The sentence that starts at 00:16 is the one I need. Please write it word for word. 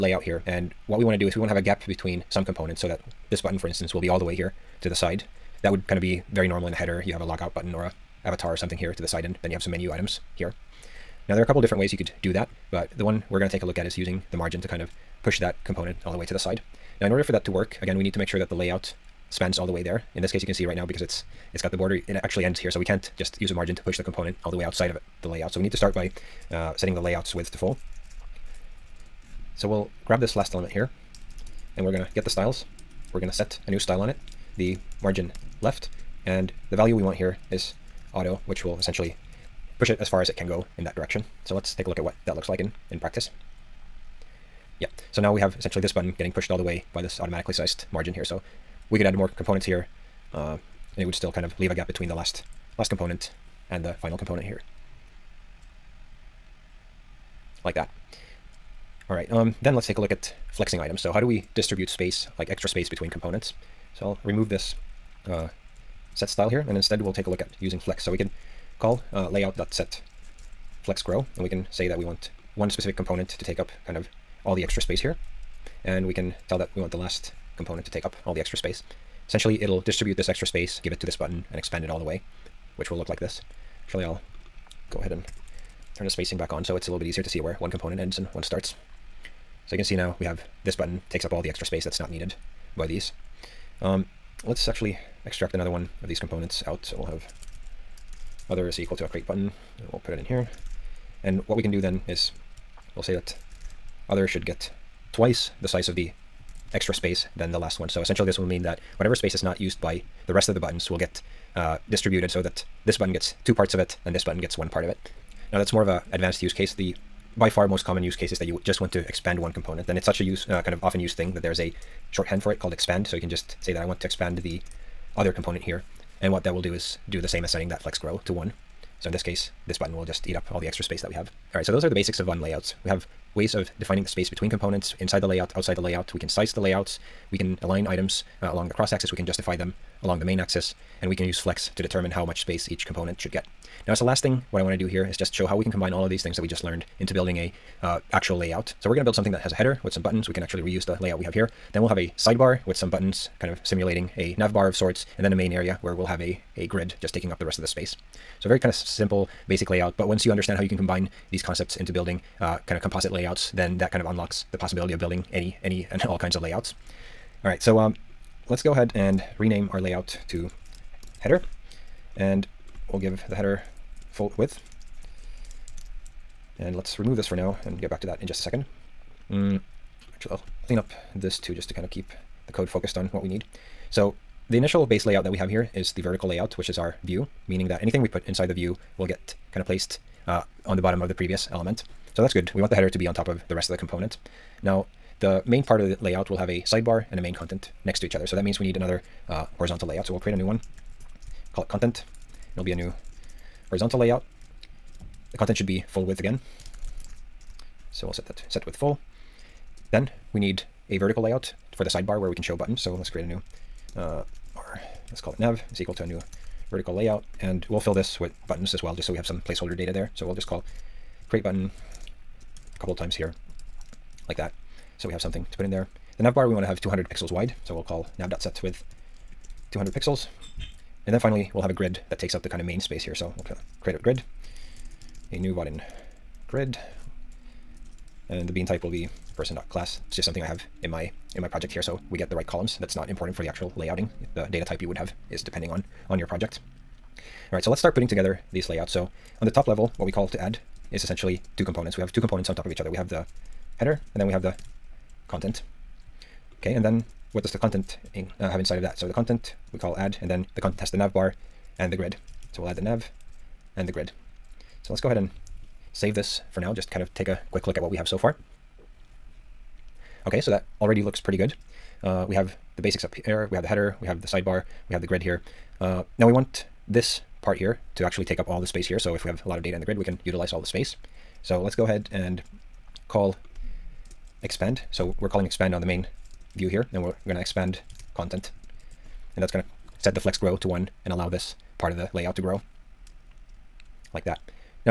Now, in order for that to work, again, we need to make sure that the layout spans all the way there.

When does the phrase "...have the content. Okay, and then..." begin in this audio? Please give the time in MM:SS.
04:14.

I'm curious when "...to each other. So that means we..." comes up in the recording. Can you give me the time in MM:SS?
03:17.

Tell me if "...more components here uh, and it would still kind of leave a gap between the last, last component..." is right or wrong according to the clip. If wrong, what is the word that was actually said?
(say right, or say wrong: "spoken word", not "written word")
right.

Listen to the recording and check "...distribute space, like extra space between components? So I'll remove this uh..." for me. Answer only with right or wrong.
right.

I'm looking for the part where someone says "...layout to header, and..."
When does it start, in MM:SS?
02:49.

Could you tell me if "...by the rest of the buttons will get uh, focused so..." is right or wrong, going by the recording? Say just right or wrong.
wrong.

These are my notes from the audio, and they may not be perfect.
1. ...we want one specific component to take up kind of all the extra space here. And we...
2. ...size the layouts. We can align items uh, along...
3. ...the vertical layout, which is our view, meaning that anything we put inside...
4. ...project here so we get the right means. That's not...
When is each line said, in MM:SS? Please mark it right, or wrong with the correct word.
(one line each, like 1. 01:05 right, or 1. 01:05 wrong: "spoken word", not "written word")
1. 01:11 right
2. 02:16 right
3. 03:05 right
4. 04:01 wrong: "columns", not "means".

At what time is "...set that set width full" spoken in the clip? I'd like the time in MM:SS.
03:28.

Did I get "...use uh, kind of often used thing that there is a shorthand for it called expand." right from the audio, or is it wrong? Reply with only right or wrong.
right.